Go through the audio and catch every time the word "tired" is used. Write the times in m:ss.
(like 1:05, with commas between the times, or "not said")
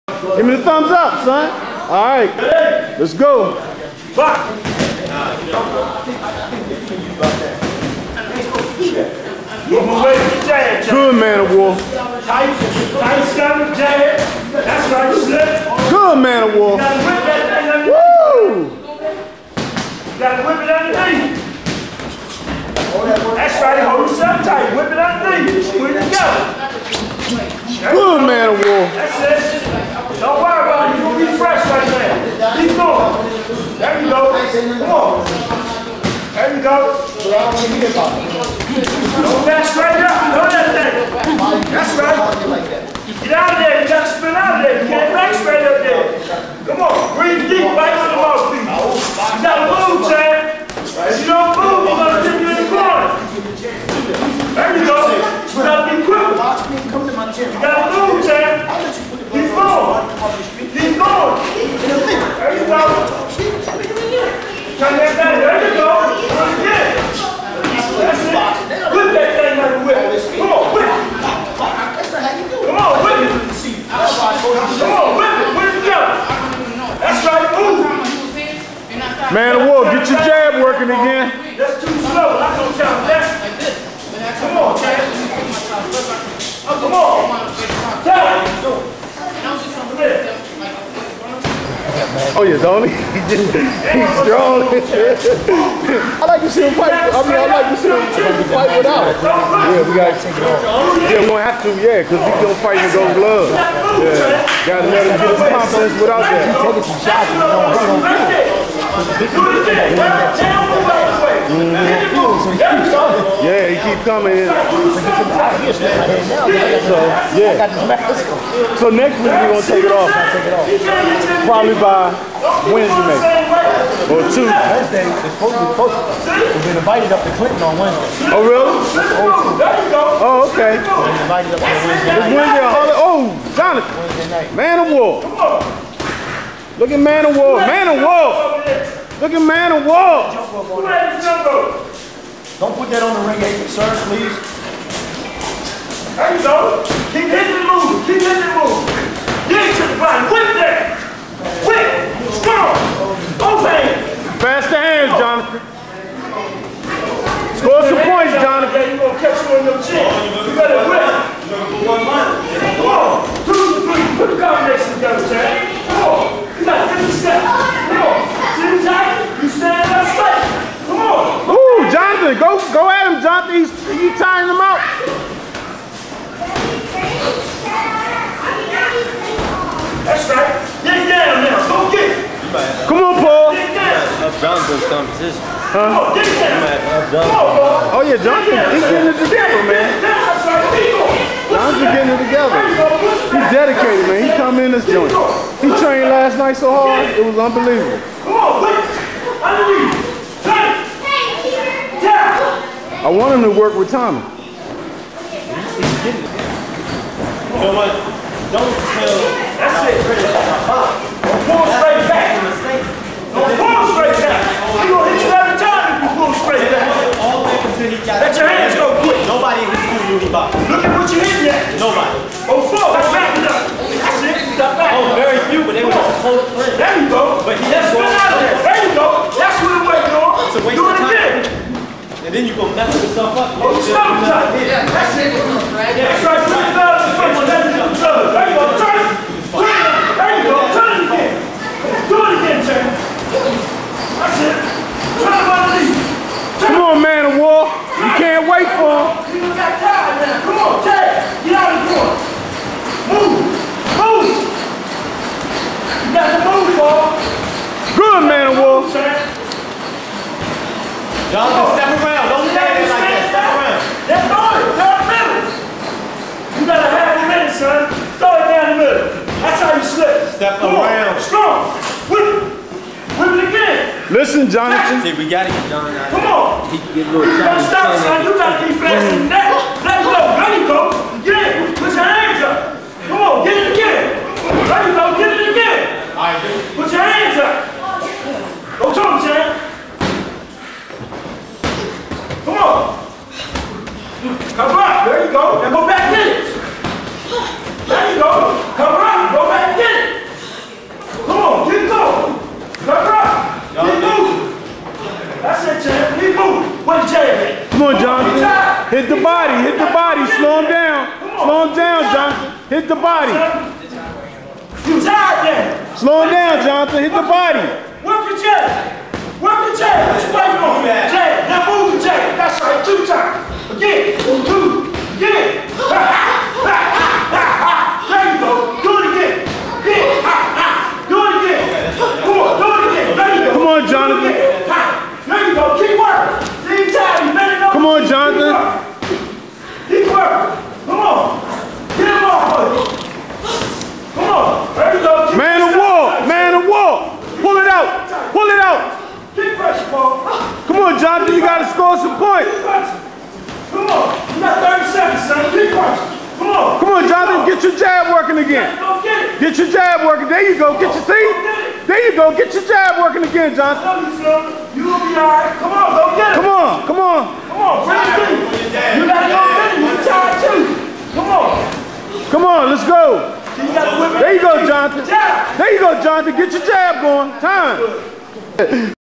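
5:14, 6:10.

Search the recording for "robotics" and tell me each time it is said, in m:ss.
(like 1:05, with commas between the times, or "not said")
not said.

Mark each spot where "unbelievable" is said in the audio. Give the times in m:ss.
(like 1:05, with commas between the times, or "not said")
3:17.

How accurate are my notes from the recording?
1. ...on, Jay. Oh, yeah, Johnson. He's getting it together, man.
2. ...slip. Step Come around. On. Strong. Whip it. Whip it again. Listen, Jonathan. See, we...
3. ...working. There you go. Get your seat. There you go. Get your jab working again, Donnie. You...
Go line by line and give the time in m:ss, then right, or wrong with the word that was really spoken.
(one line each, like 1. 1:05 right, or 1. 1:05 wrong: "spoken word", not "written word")
1. 3:07 wrong: "Paul", not "Jay"
2. 4:29 right
3. 6:00 wrong: "Johnson", not "Donnie".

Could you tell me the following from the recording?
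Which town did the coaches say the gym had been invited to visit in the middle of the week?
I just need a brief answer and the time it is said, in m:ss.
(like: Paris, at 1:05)
Clinton, at 2:07.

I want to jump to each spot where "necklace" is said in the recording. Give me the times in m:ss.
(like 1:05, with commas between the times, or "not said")
not said.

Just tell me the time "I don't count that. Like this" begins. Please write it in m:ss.
1:22.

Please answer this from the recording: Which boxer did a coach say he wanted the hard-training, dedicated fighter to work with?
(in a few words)
Tommy.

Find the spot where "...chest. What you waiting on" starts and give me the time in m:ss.
5:19.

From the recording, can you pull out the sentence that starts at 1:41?
Yeah, cause he's gonna fight with those gloves.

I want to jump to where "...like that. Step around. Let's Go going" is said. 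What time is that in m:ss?
4:22.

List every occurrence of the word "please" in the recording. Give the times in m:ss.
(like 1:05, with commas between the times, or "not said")
2:24, 3:19.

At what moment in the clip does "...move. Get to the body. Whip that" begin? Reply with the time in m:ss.
2:28.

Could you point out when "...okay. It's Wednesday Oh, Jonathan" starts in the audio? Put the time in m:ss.
2:10.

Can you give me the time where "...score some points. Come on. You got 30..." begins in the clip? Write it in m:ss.
5:51.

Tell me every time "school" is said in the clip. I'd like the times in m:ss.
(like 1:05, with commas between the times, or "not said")
3:39.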